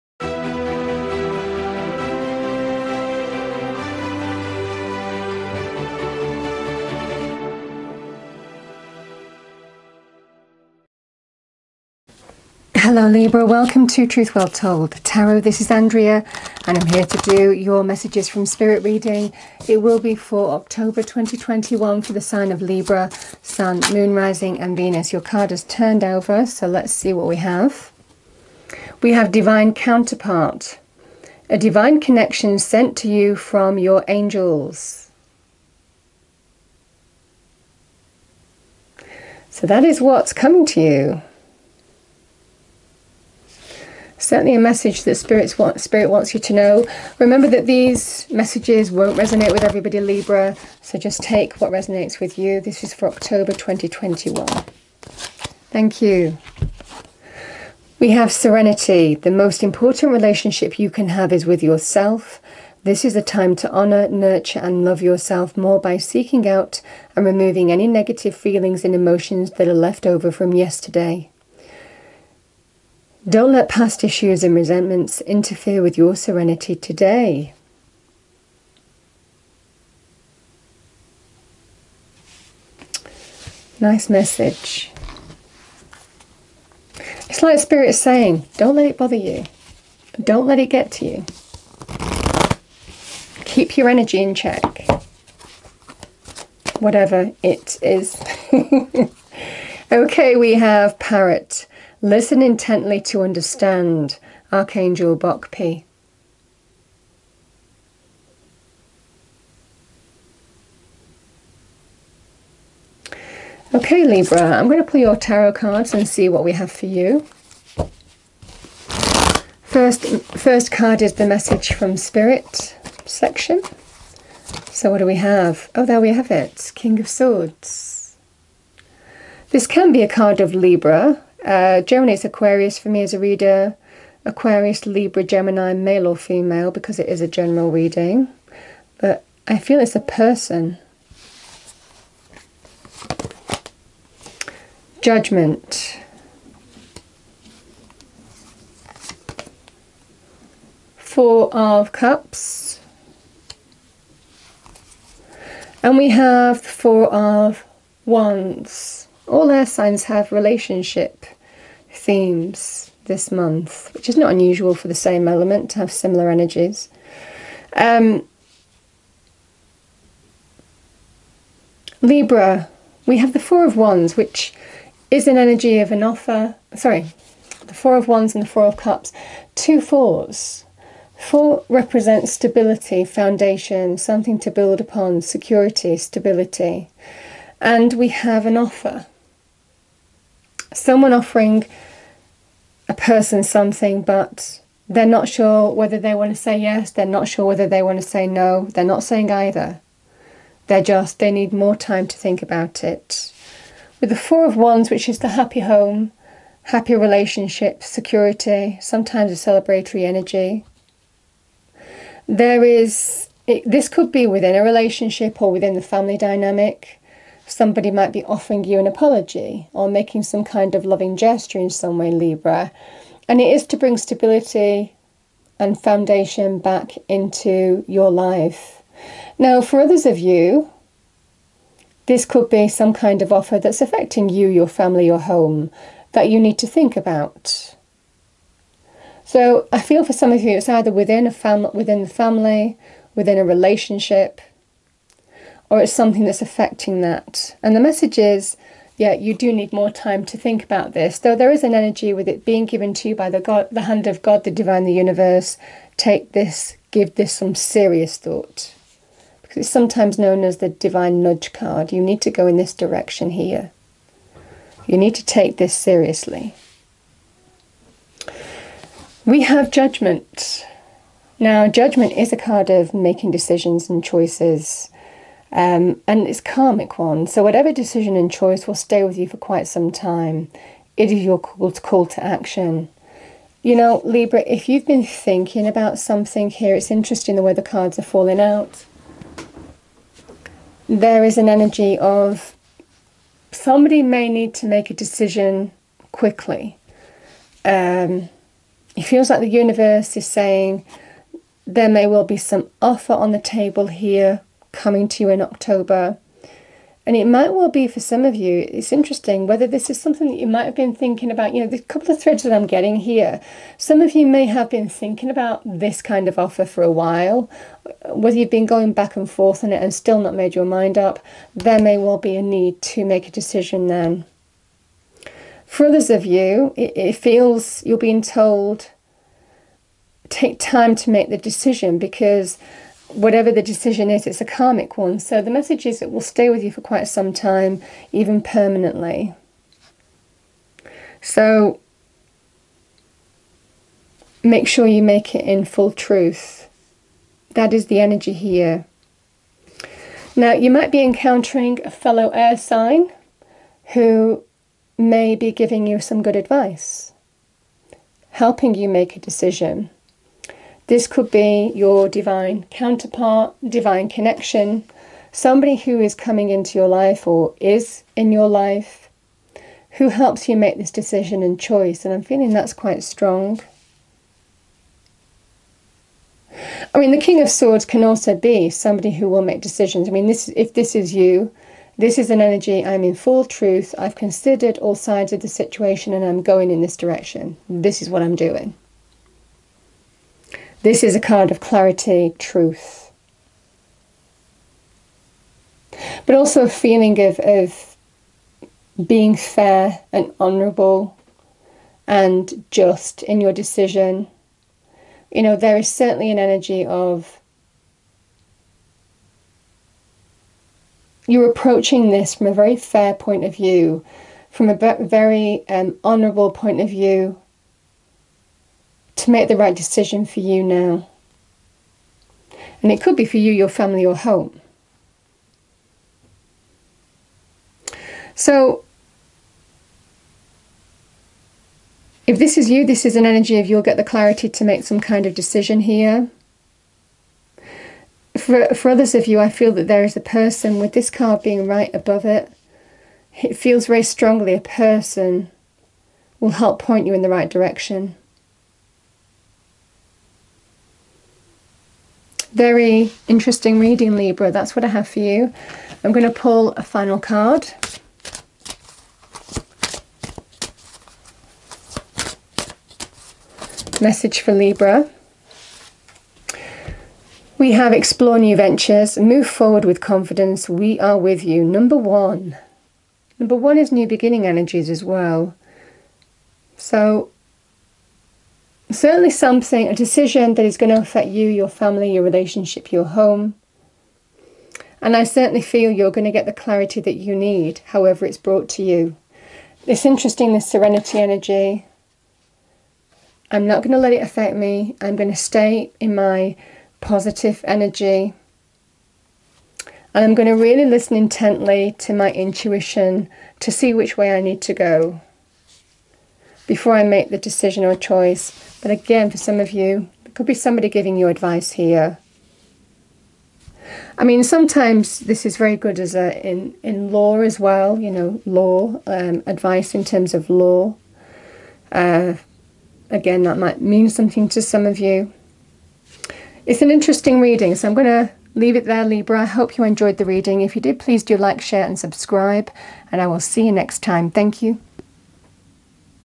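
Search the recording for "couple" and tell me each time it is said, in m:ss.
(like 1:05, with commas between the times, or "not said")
5:11.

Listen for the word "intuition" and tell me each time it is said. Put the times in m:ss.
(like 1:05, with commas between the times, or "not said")
8:22.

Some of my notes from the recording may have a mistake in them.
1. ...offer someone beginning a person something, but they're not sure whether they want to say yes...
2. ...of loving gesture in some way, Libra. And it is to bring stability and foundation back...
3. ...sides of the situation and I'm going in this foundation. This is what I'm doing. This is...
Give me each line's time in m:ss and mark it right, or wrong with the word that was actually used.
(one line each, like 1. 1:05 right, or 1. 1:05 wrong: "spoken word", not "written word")
1. 3:08 wrong: "offering", not "beginning"
2. 3:40 right
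3. 6:24 wrong: "direction", not "foundation".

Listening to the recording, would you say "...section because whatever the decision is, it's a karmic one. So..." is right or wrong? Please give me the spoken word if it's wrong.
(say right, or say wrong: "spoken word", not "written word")
wrong: "decision", not "section".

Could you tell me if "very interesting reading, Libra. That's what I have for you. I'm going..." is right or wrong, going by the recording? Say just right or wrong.
right.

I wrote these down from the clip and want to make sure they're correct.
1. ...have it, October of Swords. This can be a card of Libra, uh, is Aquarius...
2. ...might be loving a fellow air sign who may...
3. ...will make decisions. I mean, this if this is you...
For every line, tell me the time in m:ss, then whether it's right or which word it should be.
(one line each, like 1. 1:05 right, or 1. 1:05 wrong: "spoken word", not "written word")
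1. 2:06 wrong: "King", not "October"
2. 5:50 wrong: "encountering", not "loving"
3. 6:19 right.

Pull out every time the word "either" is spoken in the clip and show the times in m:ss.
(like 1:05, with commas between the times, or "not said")
3:19, 4:00.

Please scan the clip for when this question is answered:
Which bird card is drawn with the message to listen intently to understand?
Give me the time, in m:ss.
1:40.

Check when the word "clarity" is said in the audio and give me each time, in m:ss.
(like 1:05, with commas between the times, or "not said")
6:31, 7:14, 8:06.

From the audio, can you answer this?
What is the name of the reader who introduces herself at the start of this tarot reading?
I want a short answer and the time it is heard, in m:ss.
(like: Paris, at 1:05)
Andrea, at 0:15.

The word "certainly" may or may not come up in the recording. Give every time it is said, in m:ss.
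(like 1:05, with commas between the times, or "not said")
0:44, 6:45, 7:58, 8:05.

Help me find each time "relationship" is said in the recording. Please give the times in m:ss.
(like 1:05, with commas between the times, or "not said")
1:00, 2:40, 3:26, 3:34, 4:03, 8:02.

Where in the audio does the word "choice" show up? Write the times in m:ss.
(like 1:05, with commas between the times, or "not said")
4:34, 4:38, 6:11, 8:27.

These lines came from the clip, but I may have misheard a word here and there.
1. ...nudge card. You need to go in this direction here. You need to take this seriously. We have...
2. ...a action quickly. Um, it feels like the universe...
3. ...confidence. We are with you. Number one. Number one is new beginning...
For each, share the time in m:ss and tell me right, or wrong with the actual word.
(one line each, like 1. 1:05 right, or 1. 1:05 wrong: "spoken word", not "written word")
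1. 4:21 right
2. 4:54 wrong: "decision", not "action"
3. 7:50 right.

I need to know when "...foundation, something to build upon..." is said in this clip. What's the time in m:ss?
3:03.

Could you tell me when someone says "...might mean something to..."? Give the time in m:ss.
8:43.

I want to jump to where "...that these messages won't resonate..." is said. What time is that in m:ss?
0:47.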